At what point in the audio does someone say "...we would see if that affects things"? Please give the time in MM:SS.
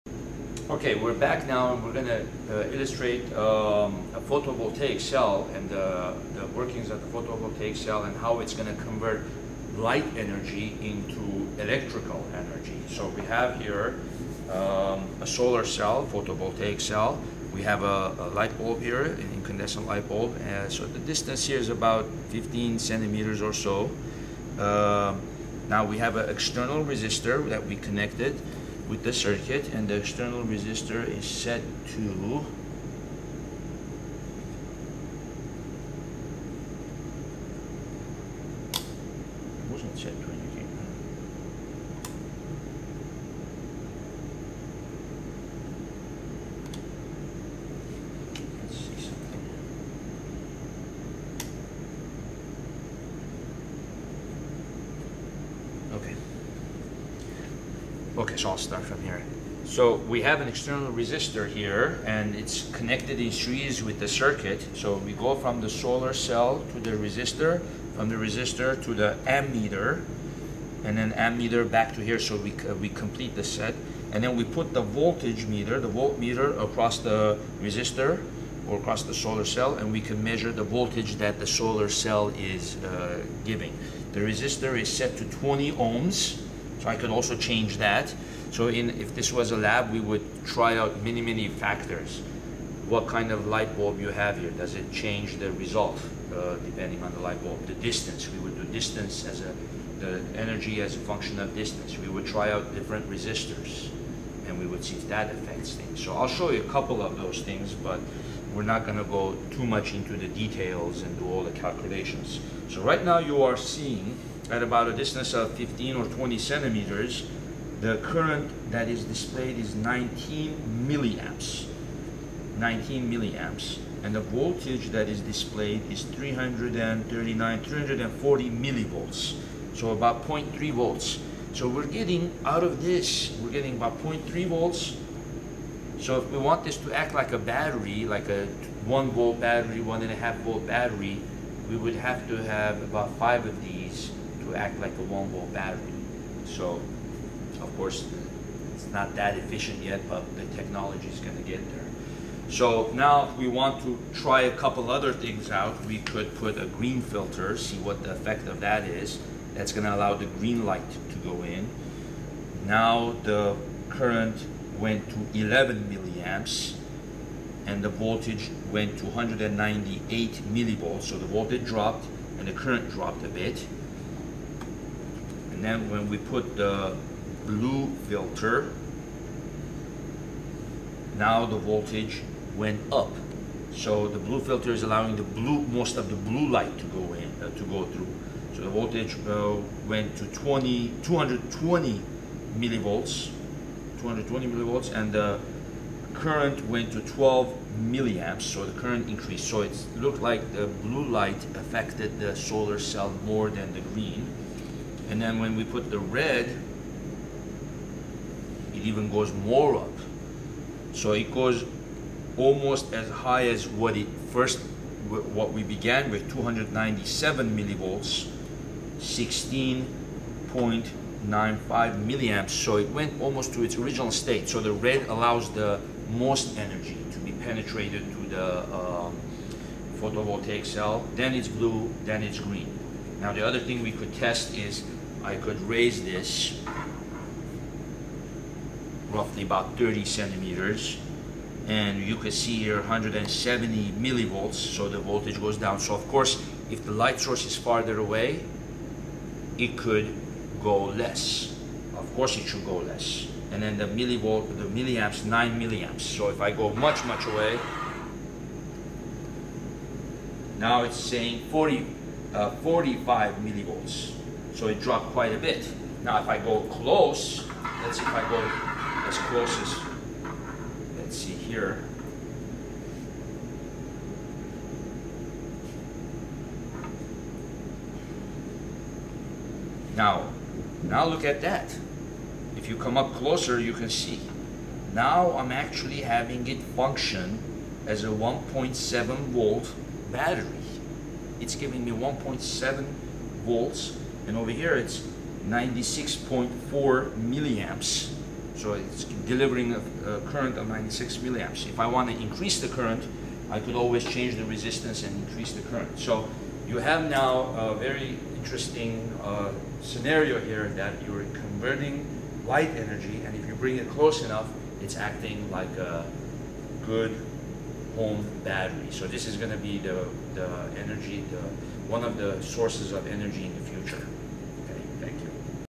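01:44.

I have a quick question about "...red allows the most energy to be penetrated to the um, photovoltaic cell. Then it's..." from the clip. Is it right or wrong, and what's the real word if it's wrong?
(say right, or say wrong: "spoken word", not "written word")
right.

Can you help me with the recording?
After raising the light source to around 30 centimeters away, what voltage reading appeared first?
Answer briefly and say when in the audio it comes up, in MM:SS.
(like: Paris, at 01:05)
170 millivolts, at 04:02.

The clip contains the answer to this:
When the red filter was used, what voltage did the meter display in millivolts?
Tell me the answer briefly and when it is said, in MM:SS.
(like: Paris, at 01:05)
297 millivolts, at 03:36.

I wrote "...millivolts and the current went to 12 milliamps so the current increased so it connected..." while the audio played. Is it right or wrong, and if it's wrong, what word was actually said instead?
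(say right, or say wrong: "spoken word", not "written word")
wrong: "looked", not "connected".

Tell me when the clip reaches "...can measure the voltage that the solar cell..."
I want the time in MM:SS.
01:19.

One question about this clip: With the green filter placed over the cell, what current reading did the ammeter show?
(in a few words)
11 milliamps.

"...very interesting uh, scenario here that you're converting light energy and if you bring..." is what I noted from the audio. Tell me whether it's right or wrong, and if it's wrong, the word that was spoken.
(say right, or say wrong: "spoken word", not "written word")
right.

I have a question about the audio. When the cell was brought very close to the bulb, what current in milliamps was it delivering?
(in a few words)
96.4 milliamps.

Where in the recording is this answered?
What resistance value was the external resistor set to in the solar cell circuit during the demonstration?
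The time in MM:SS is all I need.
01:25.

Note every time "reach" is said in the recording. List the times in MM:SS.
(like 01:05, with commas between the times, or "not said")
not said.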